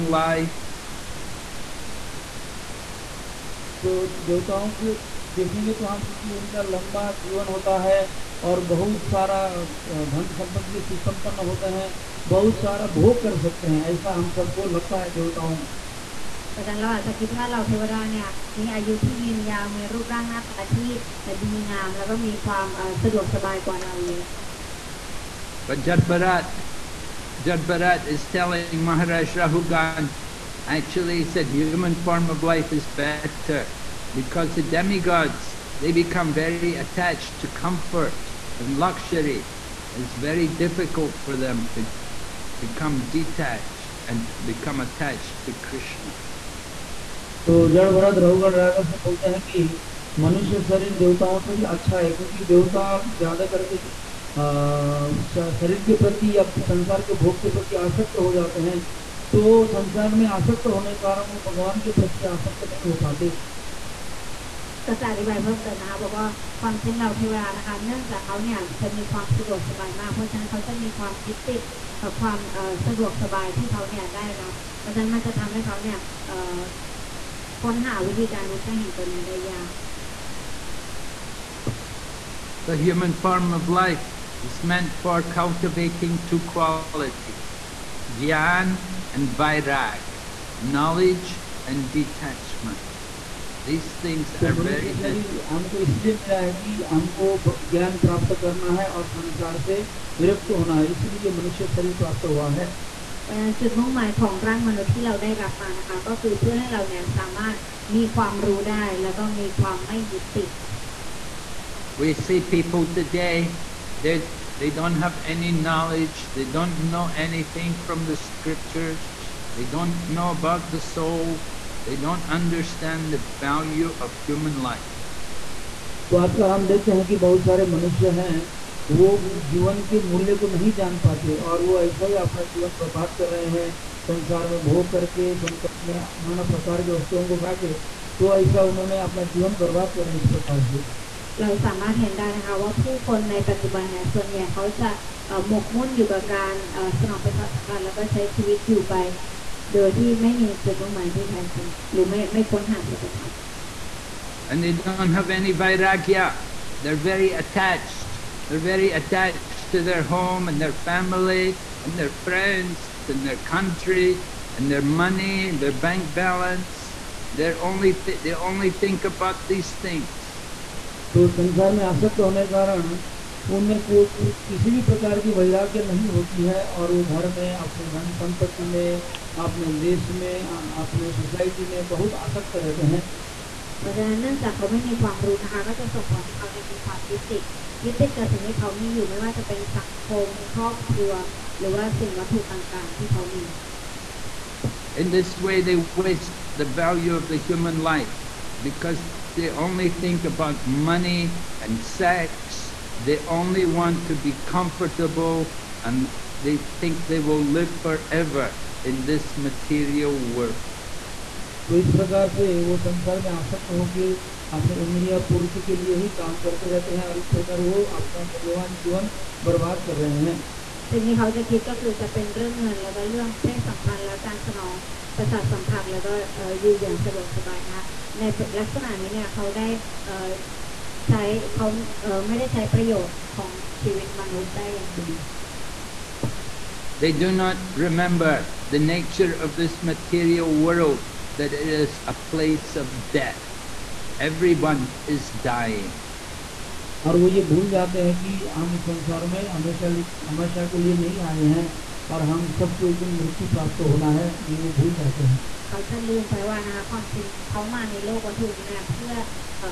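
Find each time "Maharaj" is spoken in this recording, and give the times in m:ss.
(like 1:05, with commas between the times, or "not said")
0:28.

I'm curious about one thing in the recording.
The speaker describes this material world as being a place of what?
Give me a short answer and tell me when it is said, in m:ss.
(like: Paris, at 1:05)
Death, at 4:03.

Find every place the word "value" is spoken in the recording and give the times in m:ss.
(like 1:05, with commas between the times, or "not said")
2:03, 3:16.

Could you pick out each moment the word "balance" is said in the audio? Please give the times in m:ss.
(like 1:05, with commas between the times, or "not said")
2:46.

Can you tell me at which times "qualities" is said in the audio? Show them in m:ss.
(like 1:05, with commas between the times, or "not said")
1:26.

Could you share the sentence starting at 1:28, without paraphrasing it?
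Gyan and Vairag, knowledge and detachment.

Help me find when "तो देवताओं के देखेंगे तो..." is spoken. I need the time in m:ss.
0:03.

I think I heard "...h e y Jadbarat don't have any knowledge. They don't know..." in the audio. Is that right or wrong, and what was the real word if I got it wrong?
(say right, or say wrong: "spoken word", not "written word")
wrong: "They", not "Jadbarat".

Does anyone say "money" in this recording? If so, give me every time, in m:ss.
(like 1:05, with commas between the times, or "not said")
2:45, 3:20.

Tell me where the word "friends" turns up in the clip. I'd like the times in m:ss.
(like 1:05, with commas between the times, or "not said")
2:42.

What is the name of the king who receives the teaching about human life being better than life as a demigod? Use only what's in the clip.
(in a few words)
Rahugan.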